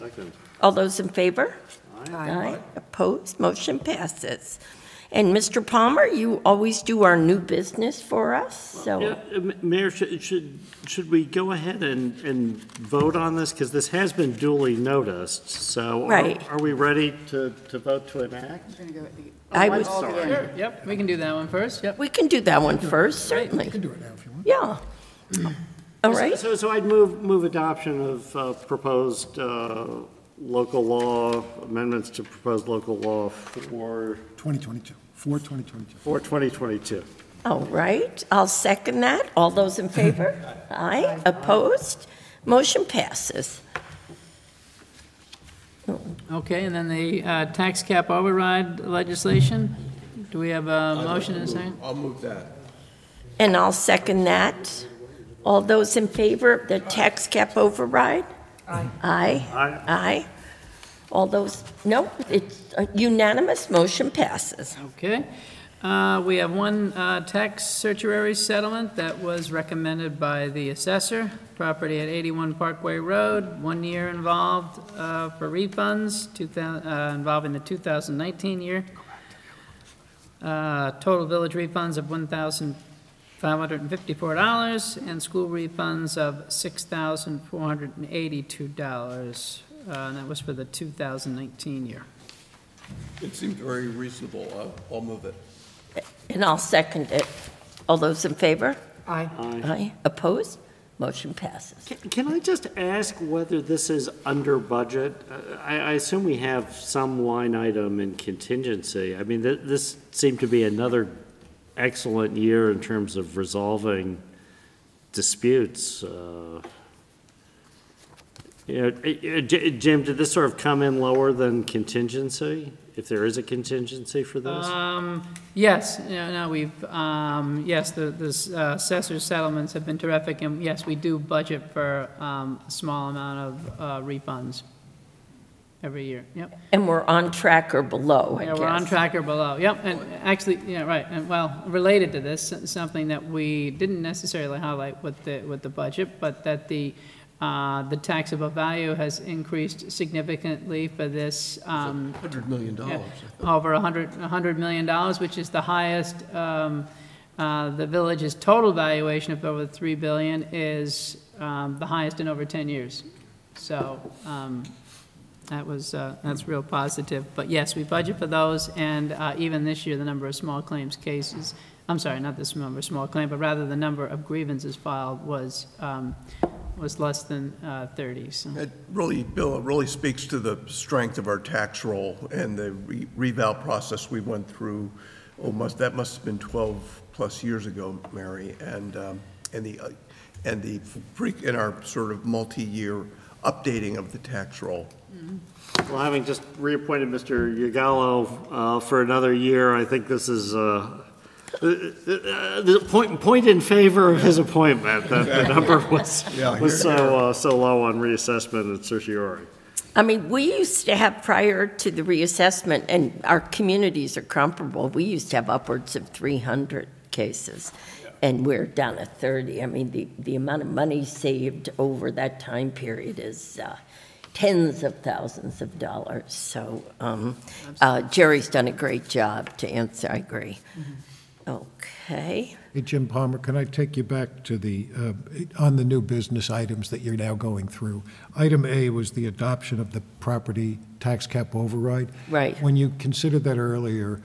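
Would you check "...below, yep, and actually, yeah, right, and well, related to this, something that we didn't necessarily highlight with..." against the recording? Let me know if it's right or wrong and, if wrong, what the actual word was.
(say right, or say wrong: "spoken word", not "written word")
right.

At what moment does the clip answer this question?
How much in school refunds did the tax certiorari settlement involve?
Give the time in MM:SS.
01:26.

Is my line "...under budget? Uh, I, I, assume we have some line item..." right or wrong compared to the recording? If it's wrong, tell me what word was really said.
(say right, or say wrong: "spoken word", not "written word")
right.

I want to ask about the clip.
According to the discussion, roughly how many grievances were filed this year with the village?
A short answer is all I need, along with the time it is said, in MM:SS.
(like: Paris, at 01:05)
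less than 30, at 02:56.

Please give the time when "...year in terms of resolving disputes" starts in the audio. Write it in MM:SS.
01:52.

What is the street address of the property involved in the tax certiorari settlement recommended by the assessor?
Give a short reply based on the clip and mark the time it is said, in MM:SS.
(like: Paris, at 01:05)
81 Parkway Road, at 01:12.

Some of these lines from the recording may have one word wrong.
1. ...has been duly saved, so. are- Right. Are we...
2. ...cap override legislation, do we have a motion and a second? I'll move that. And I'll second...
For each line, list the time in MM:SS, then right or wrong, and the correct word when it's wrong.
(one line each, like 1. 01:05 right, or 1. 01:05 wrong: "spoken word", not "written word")
1. 00:13 wrong: "noticed", not "saved"
2. 00:47 right.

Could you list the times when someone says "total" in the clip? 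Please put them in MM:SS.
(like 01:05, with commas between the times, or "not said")
01:20, 02:38.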